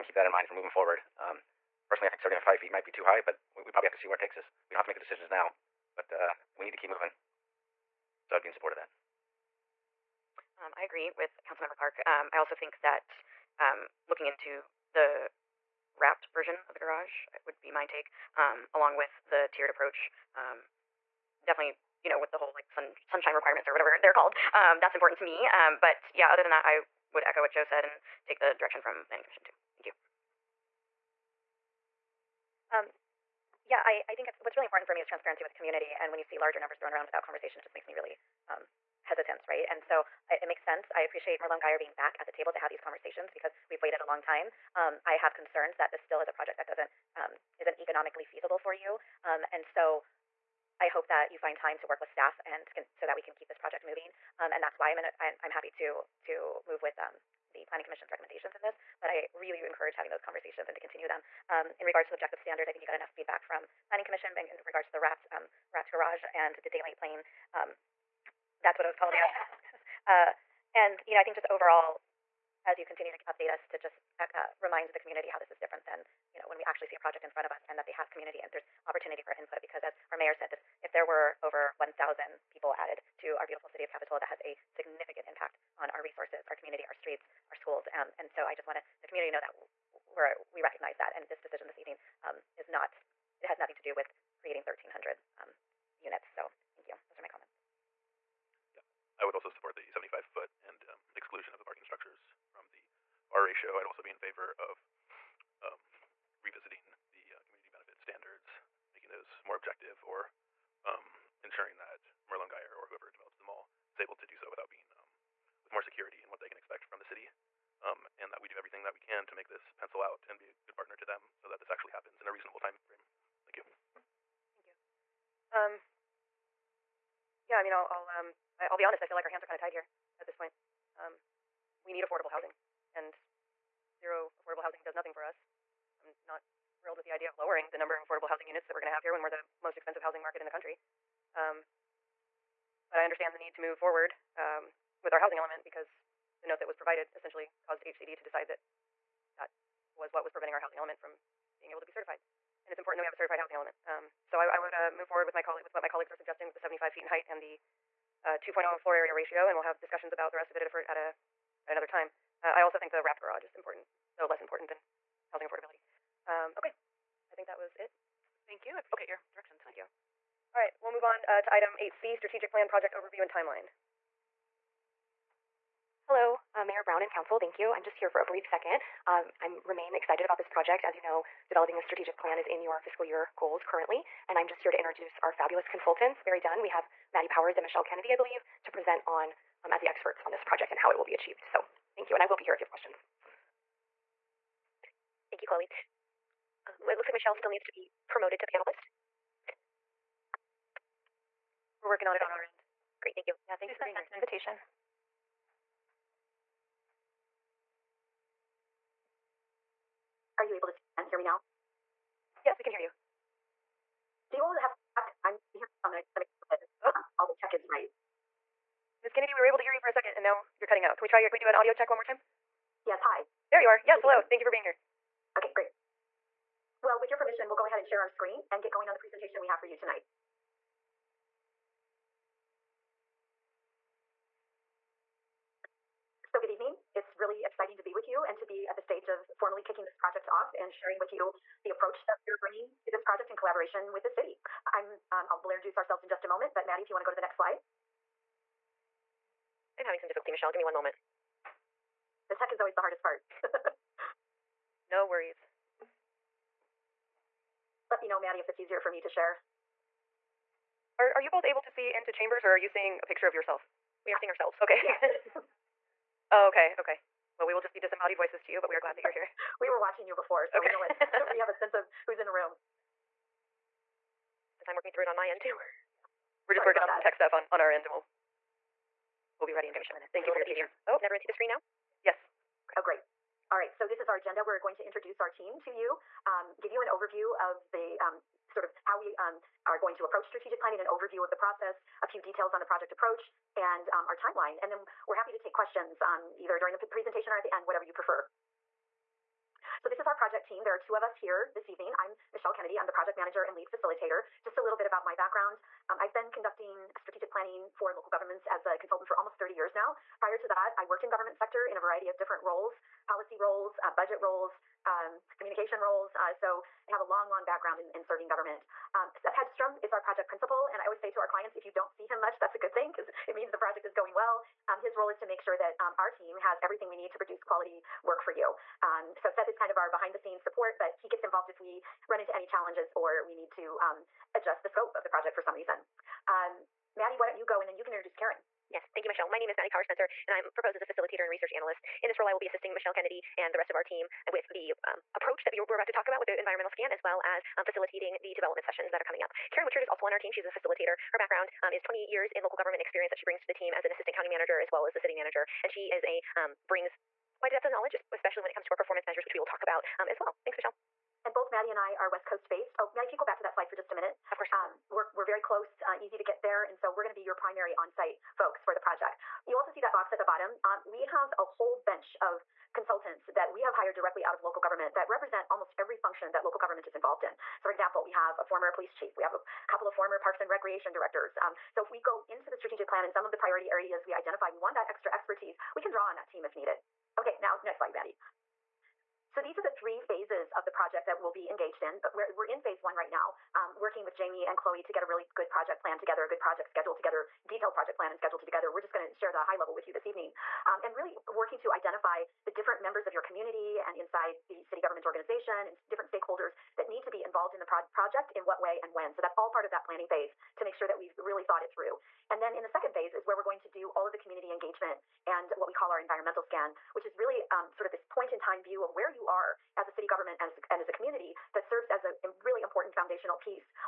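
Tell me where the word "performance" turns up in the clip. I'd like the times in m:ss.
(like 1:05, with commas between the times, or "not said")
5:58.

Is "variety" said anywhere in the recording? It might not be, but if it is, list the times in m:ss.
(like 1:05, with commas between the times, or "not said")
5:11.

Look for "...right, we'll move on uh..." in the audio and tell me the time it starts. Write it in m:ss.
2:50.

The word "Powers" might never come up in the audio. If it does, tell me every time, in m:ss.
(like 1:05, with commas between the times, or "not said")
3:07, 5:39.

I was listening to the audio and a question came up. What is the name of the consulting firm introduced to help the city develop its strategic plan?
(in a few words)
BerryDunn.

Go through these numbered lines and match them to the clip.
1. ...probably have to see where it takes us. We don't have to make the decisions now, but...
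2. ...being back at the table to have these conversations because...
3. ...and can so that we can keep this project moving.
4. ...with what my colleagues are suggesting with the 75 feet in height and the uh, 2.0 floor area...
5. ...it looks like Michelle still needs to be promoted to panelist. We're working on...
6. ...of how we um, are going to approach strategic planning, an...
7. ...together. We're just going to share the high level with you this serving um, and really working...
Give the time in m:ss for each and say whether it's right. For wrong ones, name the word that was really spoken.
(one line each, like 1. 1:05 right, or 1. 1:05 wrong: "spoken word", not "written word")
1. 0:03 right
2. 0:41 right
3. 0:52 right
4. 2:35 right
5. 3:16 right
6. 4:48 right
7. 6:38 wrong: "evening", not "serving".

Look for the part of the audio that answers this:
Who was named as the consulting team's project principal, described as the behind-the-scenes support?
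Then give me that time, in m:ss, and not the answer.
5:19.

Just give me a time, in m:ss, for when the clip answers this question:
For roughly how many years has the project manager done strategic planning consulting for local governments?
5:09.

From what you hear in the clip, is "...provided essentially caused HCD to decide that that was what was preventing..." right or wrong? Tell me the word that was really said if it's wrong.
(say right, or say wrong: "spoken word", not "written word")
right.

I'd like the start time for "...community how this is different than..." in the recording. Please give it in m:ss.
1:14.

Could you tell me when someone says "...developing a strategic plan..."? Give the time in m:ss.
3:01.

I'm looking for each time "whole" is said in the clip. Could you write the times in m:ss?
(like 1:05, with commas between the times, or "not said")
0:22, 6:11.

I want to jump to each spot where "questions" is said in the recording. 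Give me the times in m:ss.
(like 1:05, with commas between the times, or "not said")
3:12, 4:55.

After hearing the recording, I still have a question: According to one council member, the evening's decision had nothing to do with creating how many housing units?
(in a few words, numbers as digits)
1,300.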